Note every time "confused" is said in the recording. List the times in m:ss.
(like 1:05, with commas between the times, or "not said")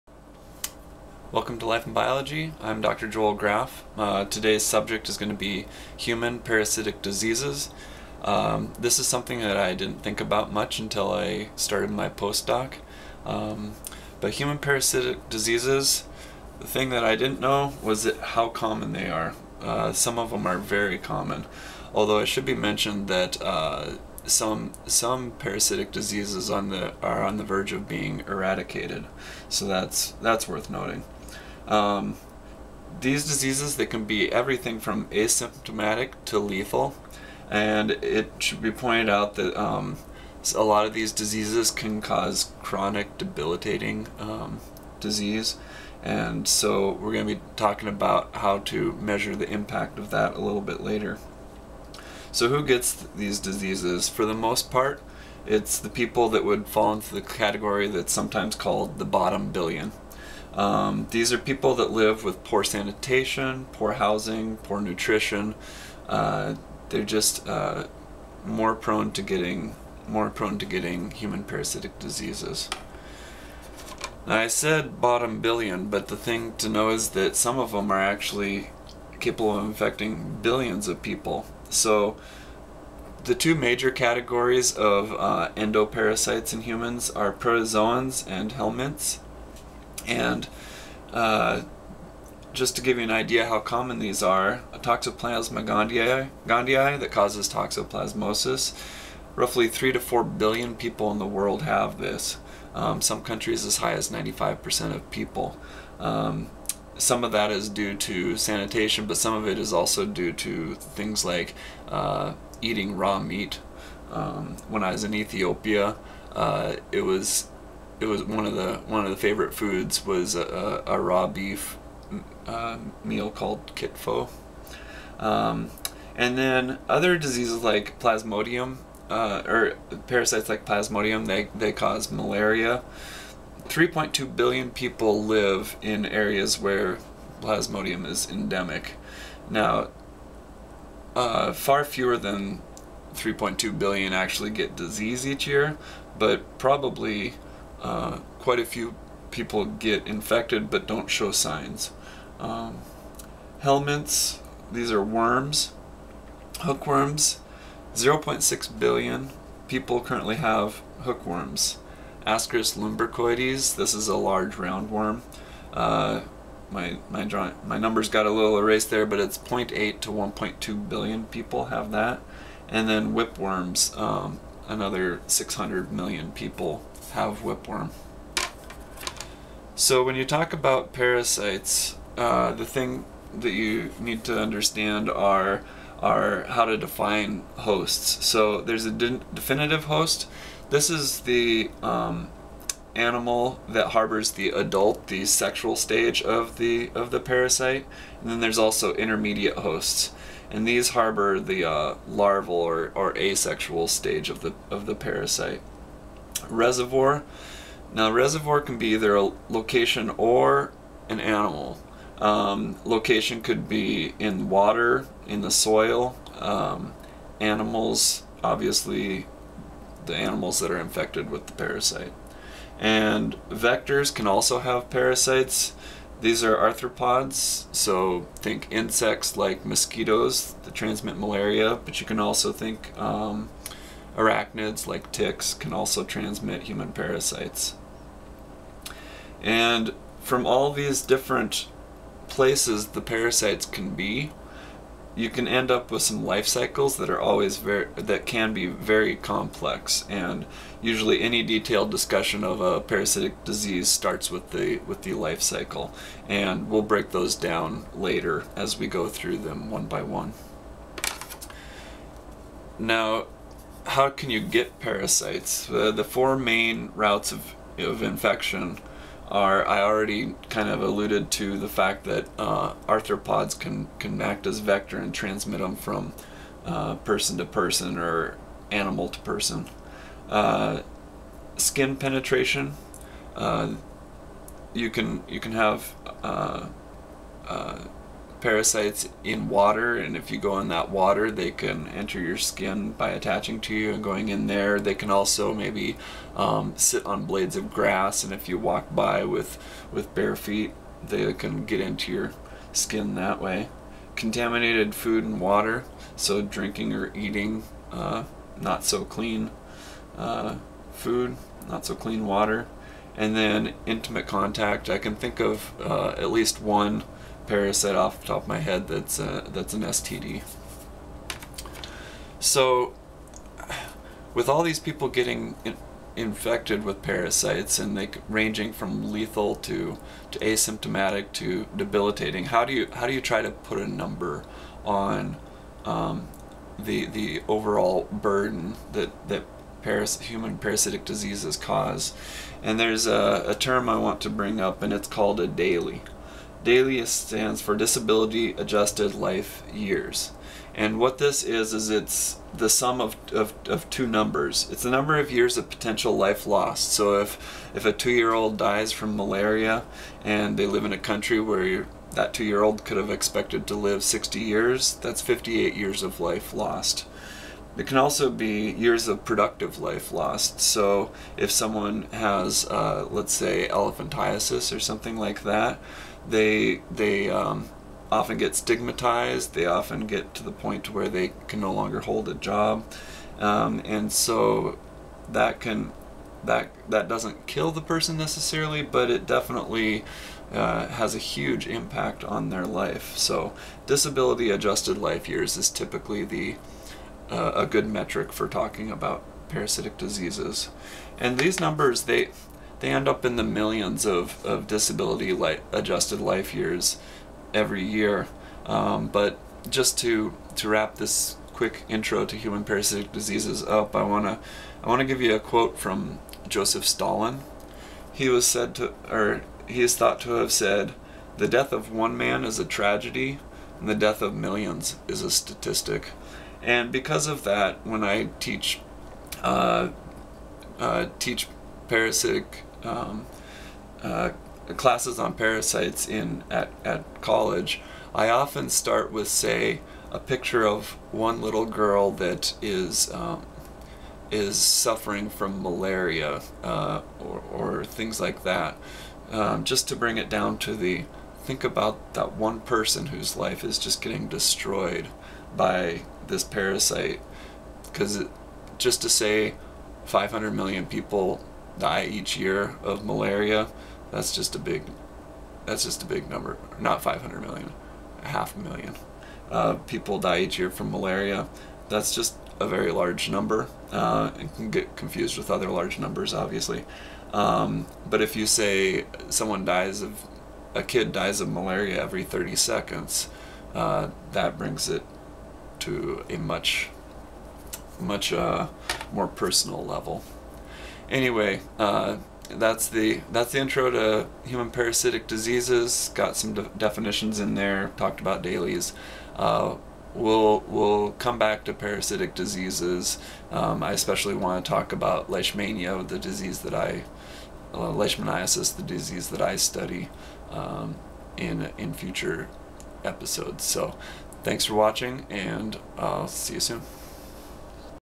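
7:54.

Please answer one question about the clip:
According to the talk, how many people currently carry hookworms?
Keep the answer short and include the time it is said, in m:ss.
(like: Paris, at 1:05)
0.6 billion, at 2:37.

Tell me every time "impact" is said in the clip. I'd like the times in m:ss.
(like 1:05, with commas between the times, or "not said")
0:49, 6:31.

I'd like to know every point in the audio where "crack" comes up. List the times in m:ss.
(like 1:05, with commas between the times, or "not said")
not said.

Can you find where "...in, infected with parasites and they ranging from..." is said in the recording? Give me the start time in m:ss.
5:25.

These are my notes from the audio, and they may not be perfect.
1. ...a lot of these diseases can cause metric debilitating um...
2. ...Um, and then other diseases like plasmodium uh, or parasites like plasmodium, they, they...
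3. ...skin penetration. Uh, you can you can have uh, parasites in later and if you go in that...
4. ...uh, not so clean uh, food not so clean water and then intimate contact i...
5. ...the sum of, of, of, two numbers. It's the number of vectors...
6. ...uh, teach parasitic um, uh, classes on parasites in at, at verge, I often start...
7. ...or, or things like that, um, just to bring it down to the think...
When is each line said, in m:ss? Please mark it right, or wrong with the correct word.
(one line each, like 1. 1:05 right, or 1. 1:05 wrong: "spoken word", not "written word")
1. 0:40 wrong: "chronic", not "metric"
2. 2:05 right
3. 4:41 wrong: "water", not "later"
4. 5:07 right
5. 5:52 wrong: "years", not "vectors"
6. 7:10 wrong: "college", not "verge"
7. 7:27 right.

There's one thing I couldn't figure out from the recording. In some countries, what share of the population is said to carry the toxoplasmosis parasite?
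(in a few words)
95%.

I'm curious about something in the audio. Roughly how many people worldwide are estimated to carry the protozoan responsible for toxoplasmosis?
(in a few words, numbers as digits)
3 to 4 billion.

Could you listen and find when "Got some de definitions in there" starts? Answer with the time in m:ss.
8:16.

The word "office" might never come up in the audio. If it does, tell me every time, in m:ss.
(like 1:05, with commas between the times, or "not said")
not said.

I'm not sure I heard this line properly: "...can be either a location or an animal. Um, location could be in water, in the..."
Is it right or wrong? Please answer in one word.
right.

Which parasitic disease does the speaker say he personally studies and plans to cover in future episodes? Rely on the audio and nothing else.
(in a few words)
leishmaniasis.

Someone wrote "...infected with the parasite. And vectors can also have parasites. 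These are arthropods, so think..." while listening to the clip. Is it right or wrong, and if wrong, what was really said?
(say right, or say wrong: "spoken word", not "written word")
right.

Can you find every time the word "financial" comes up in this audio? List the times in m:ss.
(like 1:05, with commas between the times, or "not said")
not said.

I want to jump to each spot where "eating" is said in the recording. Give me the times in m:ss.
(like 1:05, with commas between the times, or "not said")
1:52, 5:07.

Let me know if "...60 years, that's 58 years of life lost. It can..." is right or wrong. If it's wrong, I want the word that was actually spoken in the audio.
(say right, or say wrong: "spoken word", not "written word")
right.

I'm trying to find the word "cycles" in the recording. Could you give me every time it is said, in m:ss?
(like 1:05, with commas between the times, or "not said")
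4:06, 4:15.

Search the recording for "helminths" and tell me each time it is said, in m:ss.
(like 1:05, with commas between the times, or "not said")
1:28, 2:33.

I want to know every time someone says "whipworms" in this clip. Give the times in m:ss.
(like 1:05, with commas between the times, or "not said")
2:53, 2:57.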